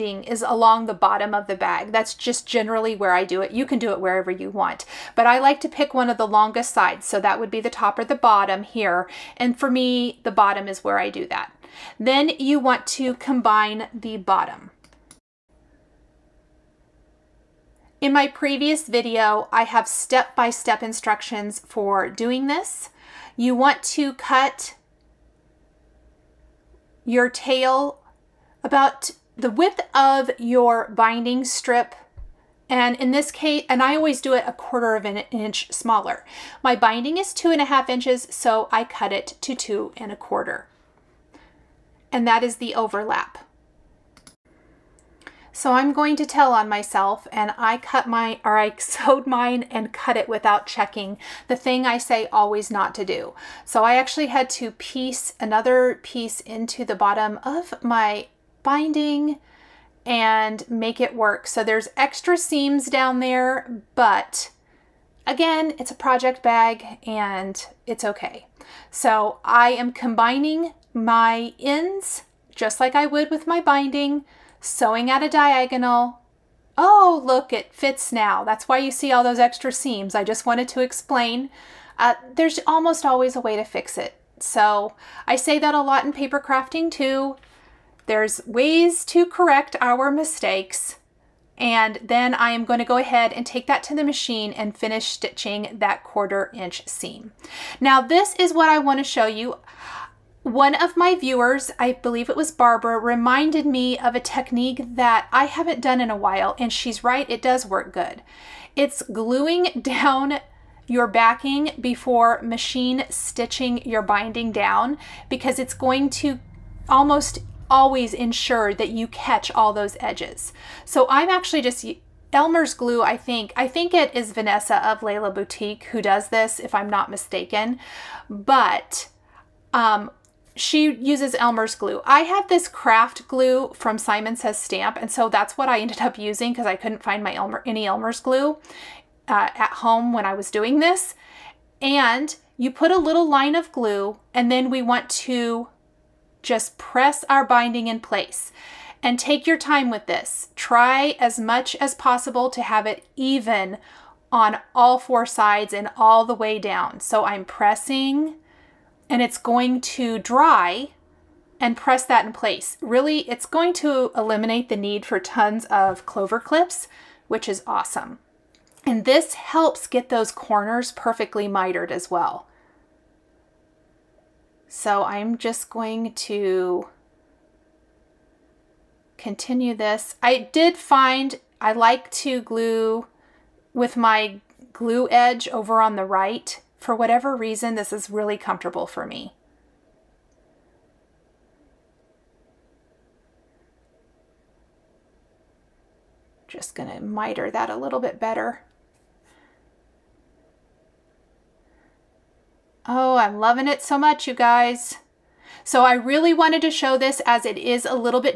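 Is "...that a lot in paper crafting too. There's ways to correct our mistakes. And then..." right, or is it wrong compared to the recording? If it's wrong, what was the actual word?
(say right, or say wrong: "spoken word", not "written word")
right.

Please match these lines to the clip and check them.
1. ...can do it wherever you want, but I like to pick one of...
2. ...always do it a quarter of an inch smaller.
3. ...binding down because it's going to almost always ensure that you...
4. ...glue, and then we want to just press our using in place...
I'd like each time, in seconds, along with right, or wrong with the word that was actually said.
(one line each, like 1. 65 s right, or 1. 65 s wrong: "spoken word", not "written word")
1. 3 s right
2. 33 s right
3. 114 s right
4. 143 s wrong: "binding", not "using".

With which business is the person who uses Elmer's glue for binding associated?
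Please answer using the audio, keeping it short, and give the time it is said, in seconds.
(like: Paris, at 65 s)
Lella Boutique, at 125 s.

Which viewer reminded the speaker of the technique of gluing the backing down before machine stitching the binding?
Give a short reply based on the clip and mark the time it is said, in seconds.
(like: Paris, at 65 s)
Barbara, at 102 s.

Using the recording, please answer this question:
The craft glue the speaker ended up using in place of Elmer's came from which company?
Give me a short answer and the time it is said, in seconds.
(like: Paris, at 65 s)
Simon Says Stamp, at 133 s.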